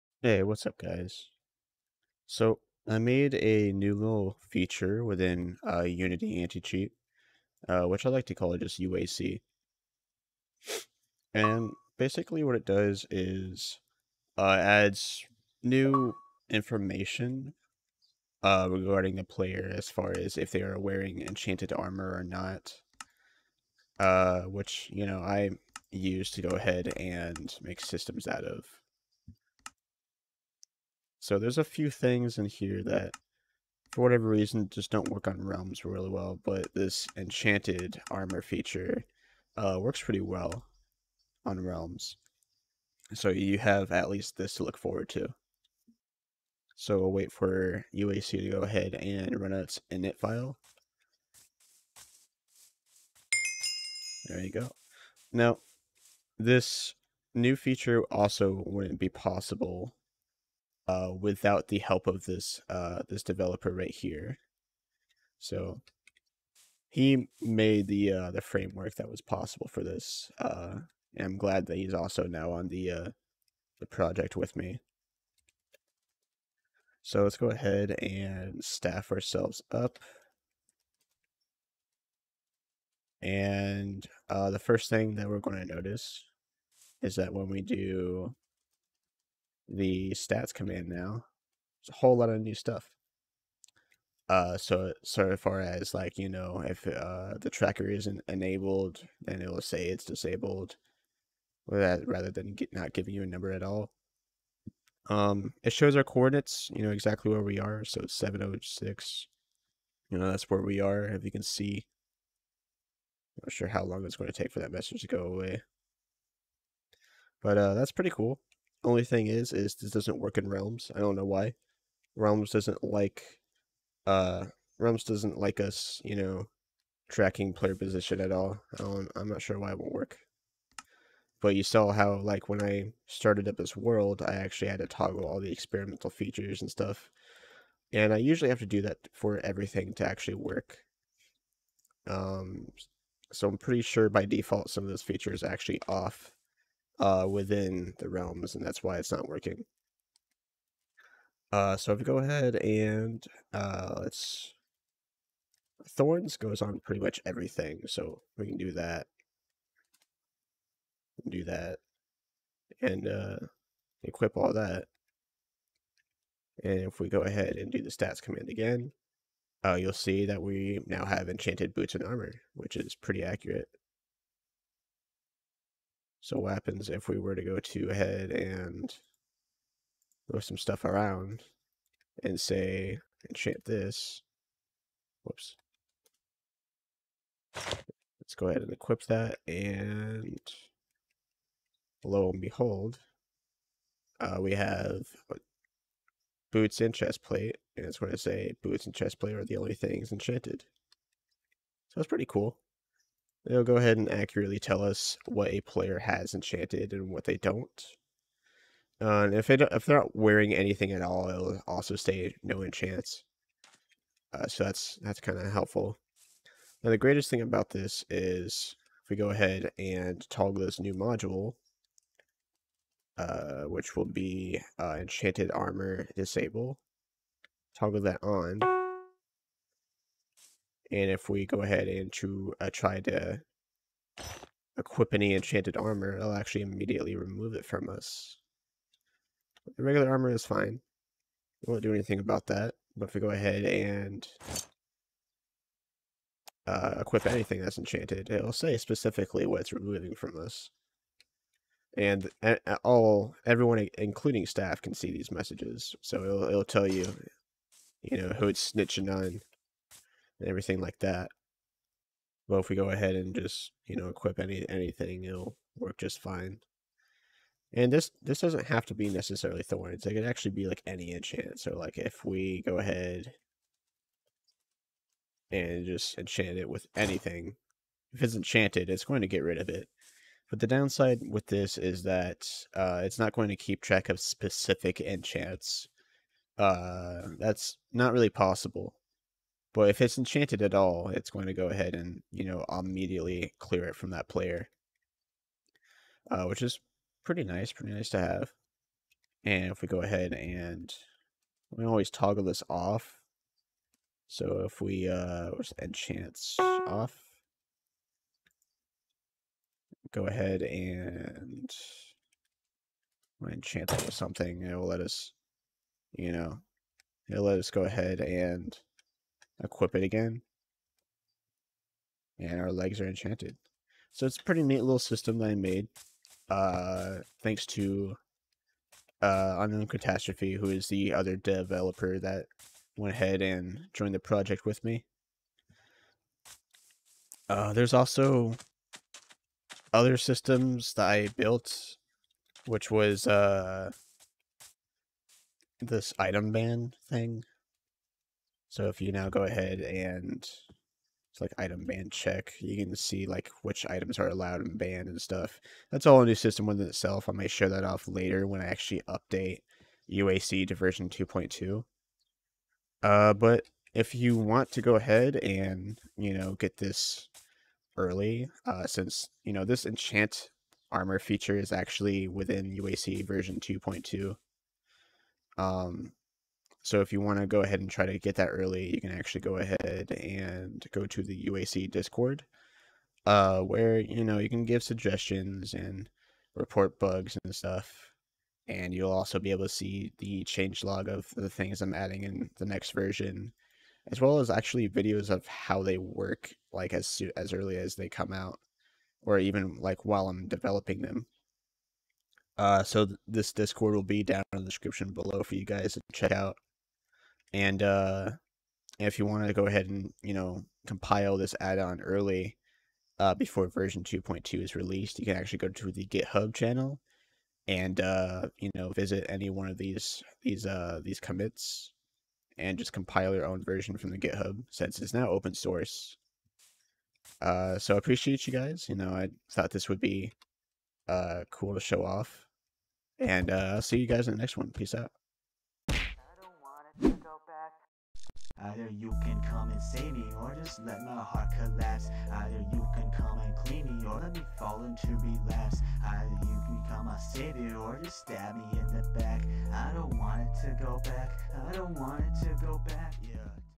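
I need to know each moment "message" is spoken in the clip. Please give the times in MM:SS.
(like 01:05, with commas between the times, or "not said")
01:54, 04:15.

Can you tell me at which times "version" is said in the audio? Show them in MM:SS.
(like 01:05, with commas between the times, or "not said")
06:00, 06:13, 06:32, 06:53, 07:03.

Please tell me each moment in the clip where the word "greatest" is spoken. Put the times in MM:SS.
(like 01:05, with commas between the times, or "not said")
03:36.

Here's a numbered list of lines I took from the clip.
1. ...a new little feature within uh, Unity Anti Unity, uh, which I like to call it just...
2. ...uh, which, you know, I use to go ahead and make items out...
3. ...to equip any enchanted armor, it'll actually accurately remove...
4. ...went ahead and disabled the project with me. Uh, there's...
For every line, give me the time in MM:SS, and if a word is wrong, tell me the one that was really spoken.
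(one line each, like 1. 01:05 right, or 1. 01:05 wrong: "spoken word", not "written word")
1. 00:03 wrong: "Cheat", not "Unity"
2. 00:23 wrong: "systems", not "items"
3. 03:53 wrong: "immediately", not "accurately"
4. 05:32 wrong: "joined", not "disabled".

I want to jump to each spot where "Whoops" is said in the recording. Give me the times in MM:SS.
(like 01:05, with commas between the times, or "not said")
03:05.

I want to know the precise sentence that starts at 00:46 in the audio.
So we'll wait for UAC to go ahead and run its init file.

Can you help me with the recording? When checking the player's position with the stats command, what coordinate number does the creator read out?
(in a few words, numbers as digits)
706.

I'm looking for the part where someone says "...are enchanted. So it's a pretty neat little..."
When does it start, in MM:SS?
05:22.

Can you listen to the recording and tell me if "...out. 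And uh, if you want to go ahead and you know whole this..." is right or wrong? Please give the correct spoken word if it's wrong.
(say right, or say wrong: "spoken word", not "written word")
wrong: "compile", not "whole".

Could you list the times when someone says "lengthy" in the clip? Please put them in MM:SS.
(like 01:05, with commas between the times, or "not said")
not said.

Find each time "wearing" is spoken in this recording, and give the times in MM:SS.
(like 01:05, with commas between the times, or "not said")
00:20, 03:30.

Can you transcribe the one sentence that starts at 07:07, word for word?
Uh, so I appreciate you guys.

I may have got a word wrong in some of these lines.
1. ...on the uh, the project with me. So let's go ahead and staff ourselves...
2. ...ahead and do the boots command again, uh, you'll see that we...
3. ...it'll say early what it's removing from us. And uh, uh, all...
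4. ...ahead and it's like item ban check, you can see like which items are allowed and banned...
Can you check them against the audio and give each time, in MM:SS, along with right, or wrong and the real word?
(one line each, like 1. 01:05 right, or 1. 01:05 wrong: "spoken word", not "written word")
1. 01:12 right
2. 02:47 wrong: "stats", not "boots"
3. 04:08 wrong: "specifically", not "early"
4. 05:49 right.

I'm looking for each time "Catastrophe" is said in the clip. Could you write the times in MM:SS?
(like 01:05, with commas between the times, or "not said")
05:29.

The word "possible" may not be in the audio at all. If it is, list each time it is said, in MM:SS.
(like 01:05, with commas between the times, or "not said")
00:59, 01:09, 04:48.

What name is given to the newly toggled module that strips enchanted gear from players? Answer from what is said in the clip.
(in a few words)
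Enchanted armor disable.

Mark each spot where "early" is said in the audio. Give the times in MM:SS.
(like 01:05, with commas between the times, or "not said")
06:07, 06:18, 06:37, 06:52.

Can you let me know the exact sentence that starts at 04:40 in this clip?
But the downside with this is that uh, it's not going to keep track of specific enchants.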